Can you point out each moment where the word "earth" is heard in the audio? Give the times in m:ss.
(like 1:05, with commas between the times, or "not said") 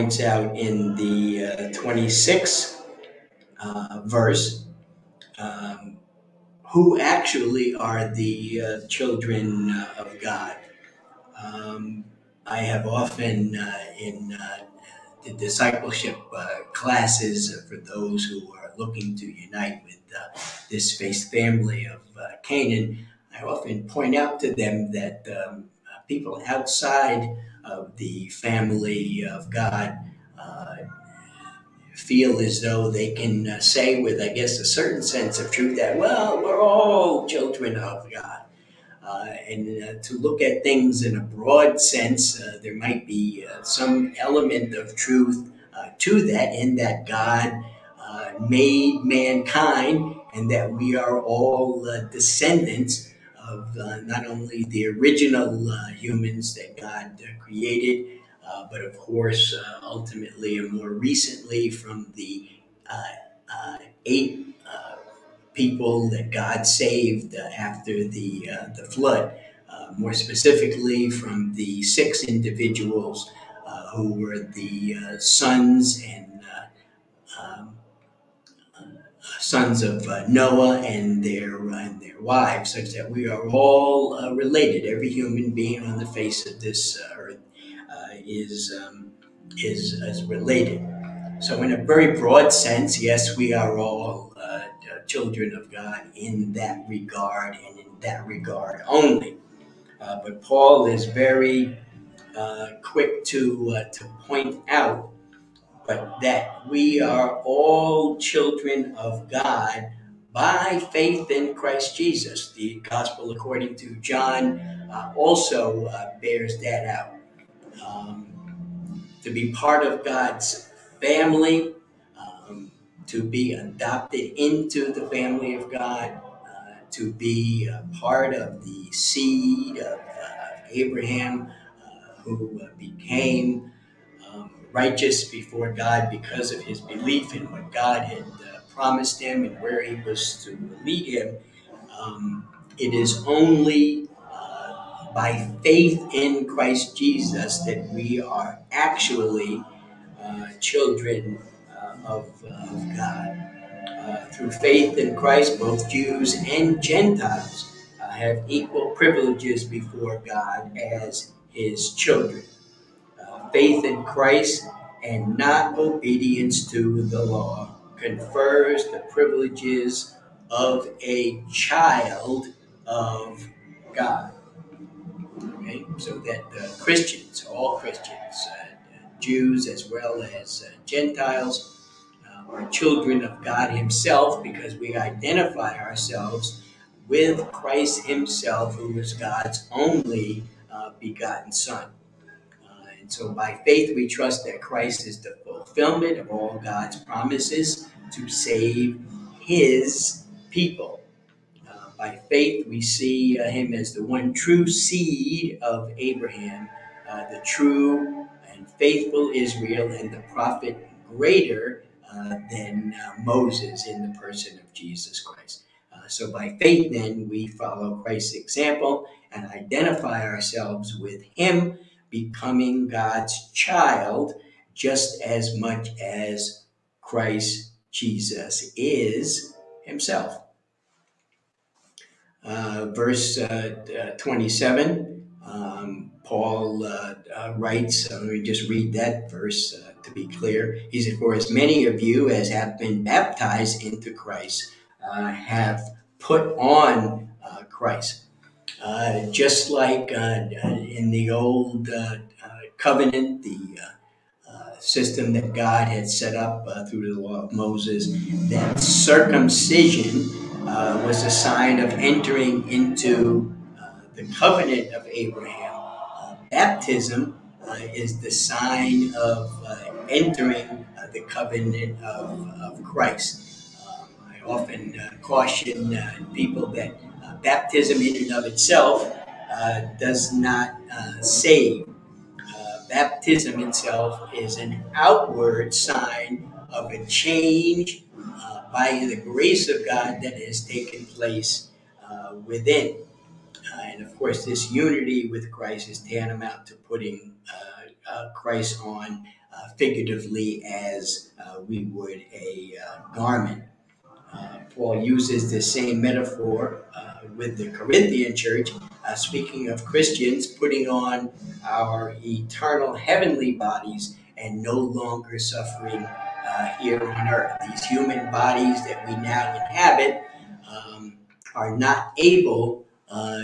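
1:27, 5:17.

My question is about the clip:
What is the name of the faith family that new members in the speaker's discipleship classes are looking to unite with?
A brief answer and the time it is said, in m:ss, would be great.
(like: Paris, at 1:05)
Canaan, at 0:22.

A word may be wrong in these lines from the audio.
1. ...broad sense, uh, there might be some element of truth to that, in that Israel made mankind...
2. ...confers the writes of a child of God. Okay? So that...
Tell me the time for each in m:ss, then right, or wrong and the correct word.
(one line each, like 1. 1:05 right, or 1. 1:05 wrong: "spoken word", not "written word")
1. 0:41 wrong: "God", not "Israel"
2. 2:47 wrong: "privileges", not "writes".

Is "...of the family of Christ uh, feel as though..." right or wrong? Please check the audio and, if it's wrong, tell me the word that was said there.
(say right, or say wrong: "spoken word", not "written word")
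wrong: "God", not "Christ".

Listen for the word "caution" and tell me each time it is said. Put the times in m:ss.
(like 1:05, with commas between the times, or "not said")
4:35.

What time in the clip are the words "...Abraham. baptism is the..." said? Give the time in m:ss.
4:25.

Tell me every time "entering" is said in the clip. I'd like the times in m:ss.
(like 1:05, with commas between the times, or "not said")
4:21, 4:30.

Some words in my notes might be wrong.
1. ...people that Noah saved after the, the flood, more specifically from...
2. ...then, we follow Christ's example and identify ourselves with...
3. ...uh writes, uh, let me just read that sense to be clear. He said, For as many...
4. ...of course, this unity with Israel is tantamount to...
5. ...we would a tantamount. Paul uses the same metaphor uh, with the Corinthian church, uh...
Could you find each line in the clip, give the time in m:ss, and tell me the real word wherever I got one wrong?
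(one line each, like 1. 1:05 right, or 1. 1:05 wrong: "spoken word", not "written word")
1. 1:05 wrong: "God", not "Noah"
2. 3:36 right
3. 3:57 wrong: "verse", not "sense"
4. 4:54 wrong: "Christ", not "Israel"
5. 5:01 wrong: "garment", not "tantamount".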